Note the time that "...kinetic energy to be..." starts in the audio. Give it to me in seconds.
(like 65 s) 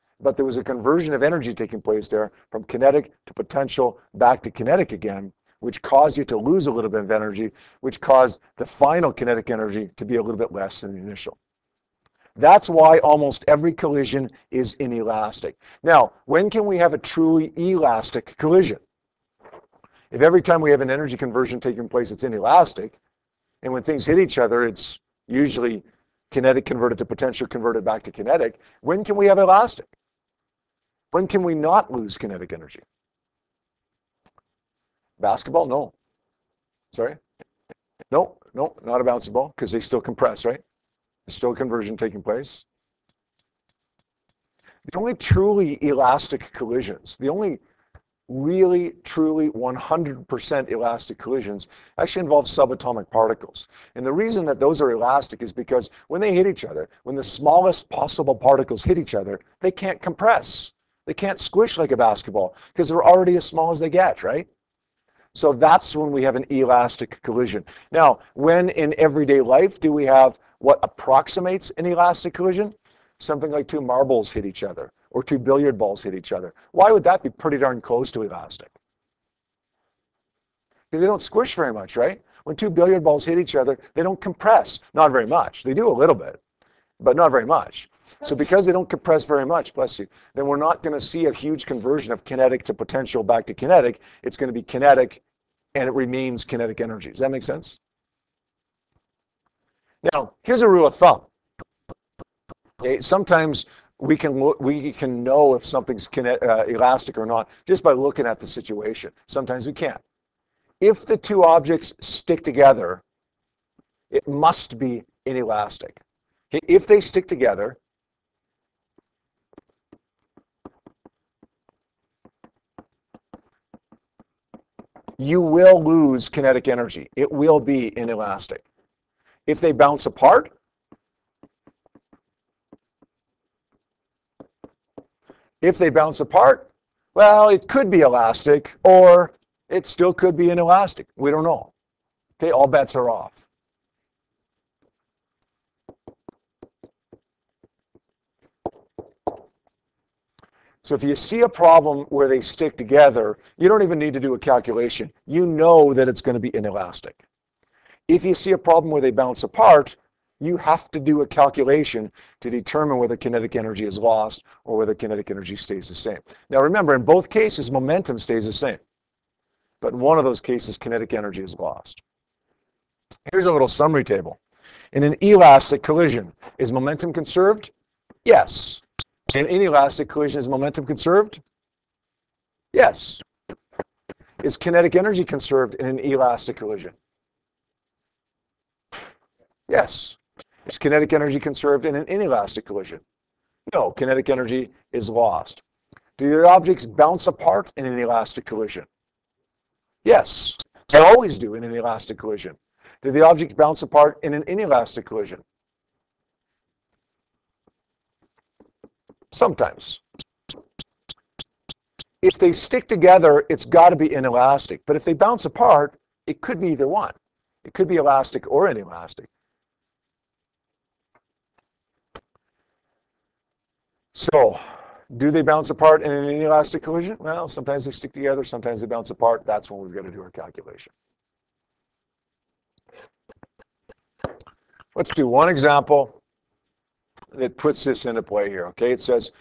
9 s.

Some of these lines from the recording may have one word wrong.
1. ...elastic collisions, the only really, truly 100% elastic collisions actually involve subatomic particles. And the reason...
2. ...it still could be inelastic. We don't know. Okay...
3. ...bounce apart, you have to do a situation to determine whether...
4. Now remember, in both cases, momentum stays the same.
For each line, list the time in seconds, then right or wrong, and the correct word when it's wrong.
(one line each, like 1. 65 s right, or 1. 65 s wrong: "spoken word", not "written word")
1. 45 s right
2. 139 s right
3. 159 s wrong: "calculation", not "situation"
4. 166 s right.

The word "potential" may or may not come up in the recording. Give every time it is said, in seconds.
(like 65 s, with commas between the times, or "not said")
3 s, 27 s, 92 s.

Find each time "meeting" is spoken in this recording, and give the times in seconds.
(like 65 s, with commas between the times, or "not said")
not said.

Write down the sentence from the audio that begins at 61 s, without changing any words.
They can't squish like a basketball because they're already as small as they get, right?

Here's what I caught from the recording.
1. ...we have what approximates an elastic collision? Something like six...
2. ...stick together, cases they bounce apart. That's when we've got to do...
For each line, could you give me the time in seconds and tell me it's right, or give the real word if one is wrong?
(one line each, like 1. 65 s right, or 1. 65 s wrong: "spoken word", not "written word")
1. 69 s wrong: "two", not "six"
2. 227 s wrong: "sometimes", not "cases".